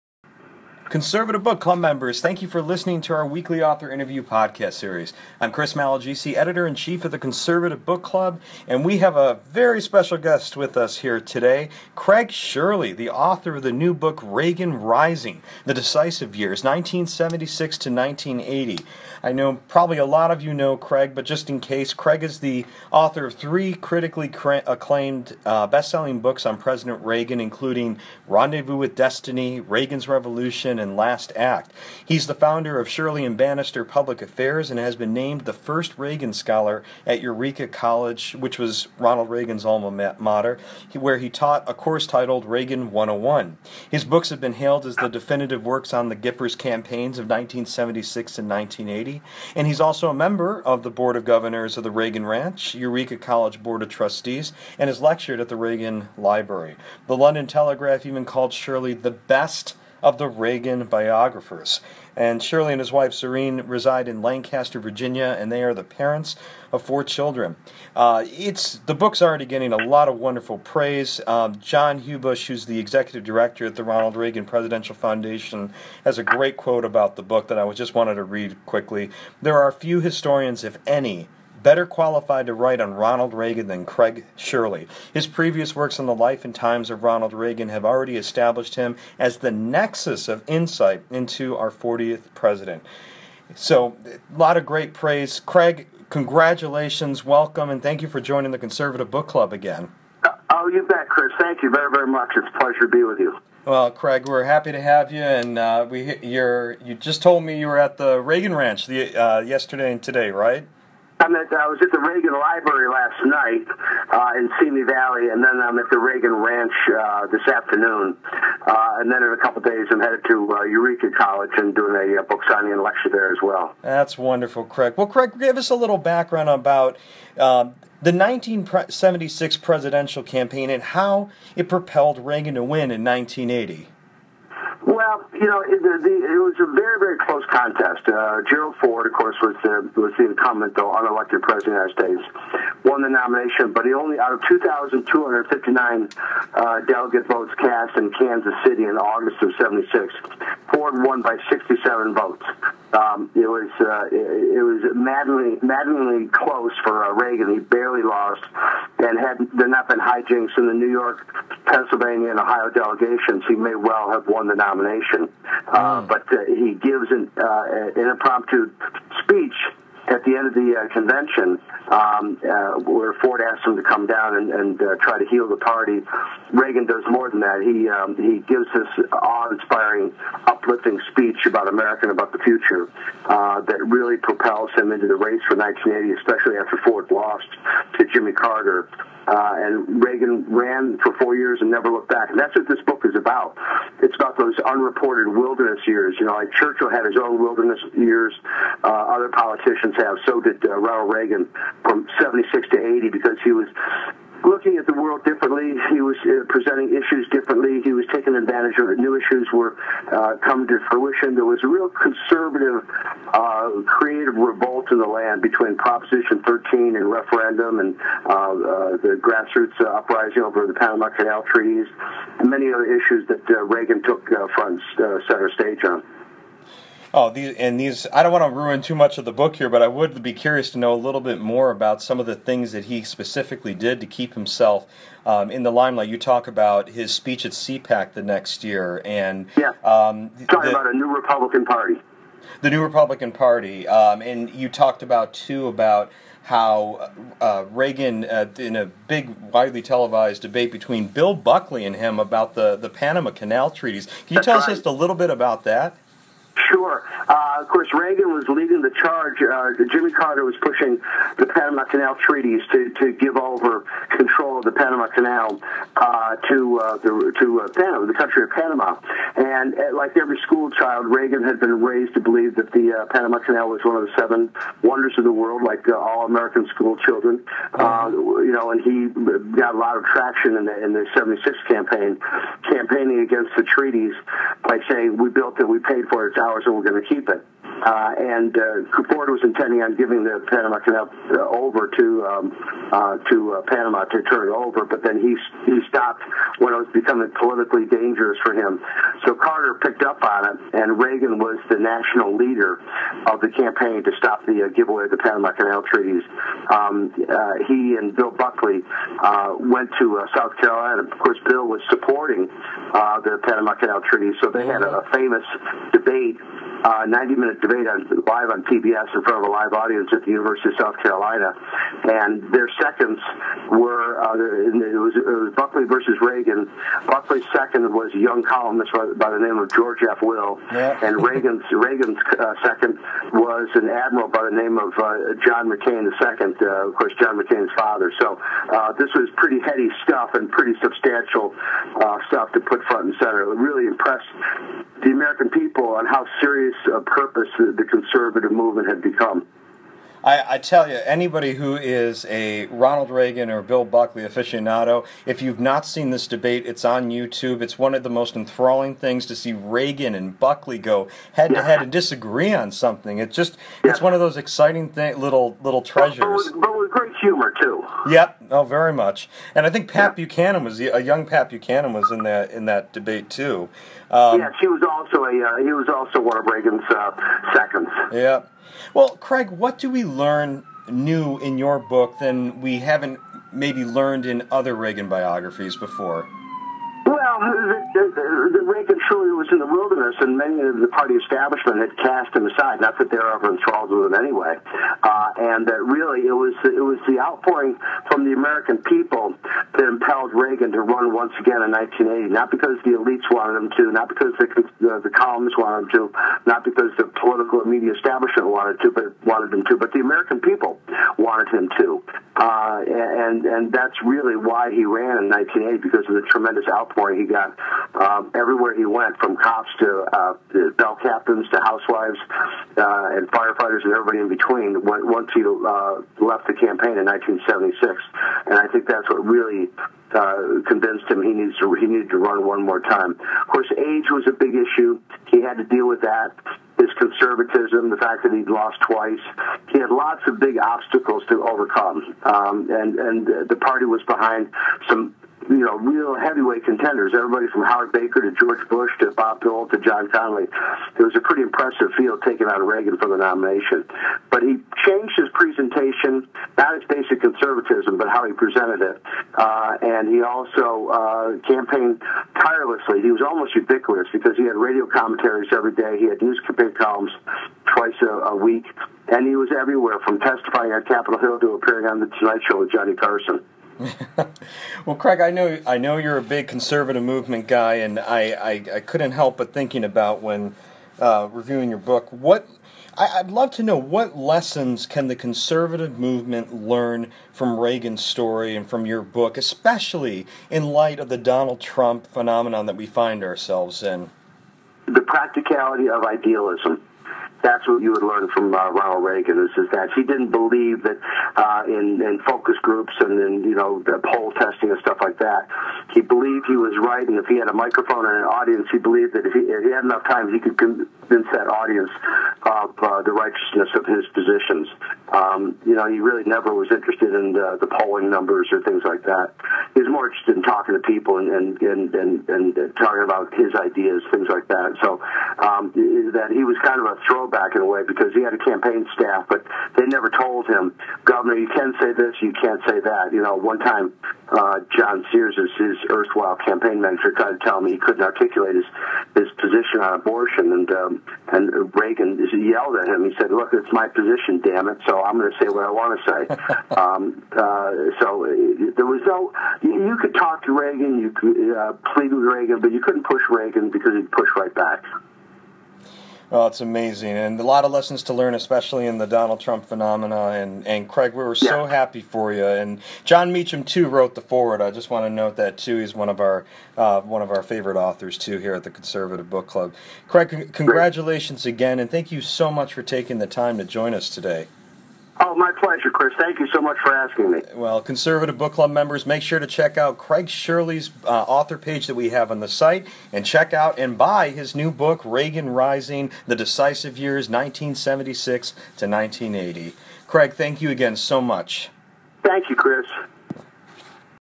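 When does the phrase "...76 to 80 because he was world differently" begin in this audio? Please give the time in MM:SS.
03:22.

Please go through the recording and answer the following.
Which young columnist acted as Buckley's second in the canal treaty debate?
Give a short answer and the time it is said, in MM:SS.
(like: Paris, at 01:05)
George F. Will, at 05:29.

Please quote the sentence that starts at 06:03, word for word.
It's just, it's one of those exciting little little treasures.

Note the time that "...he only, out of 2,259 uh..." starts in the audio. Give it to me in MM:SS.
02:23.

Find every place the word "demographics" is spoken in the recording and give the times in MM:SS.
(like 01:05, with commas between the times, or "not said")
not said.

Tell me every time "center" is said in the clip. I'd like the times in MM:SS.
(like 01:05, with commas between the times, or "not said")
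03:44, 05:43.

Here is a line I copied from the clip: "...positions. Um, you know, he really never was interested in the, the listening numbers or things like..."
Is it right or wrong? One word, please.
wrong.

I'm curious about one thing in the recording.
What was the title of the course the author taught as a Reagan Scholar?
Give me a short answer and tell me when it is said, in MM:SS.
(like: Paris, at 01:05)
Reagan 101, at 00:42.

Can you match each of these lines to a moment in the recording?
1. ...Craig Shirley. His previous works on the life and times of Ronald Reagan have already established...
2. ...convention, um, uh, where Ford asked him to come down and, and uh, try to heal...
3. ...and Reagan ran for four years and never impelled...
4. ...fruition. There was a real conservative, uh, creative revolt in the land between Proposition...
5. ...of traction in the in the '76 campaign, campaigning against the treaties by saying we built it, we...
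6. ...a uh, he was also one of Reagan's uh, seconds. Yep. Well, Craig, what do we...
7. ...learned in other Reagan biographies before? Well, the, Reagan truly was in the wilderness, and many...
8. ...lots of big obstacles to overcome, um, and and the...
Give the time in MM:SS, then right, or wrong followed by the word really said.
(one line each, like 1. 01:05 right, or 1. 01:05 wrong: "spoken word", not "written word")
1. 01:23 right
2. 02:50 right
3. 03:09 wrong: "looked", not "impelled"
4. 03:30 right
5. 04:39 right
6. 06:15 right
7. 06:23 right
8. 07:19 right.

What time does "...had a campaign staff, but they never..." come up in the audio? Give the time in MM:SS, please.
08:48.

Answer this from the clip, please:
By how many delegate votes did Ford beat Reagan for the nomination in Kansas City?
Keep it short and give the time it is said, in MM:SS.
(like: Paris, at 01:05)
67, at 02:31.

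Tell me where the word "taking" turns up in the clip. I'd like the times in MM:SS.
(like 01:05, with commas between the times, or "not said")
03:28, 09:32.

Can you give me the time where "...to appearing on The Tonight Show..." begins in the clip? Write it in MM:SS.
07:51.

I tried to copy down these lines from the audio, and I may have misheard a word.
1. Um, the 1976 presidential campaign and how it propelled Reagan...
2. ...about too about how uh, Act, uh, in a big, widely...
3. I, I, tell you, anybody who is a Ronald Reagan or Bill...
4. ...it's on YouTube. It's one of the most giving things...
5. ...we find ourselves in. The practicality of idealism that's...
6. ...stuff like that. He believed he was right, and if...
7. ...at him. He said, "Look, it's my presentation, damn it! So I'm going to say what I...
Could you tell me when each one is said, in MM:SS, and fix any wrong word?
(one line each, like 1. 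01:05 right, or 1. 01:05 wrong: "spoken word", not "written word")
1. 02:07 right
2. 04:05 wrong: "Reagan", not "Act"
3. 05:50 right
4. 05:56 wrong: "enthralling", not "giving"
5. 08:12 right
6. 08:24 right
7. 09:02 wrong: "position", not "presentation".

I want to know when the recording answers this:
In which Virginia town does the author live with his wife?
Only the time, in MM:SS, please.
01:04.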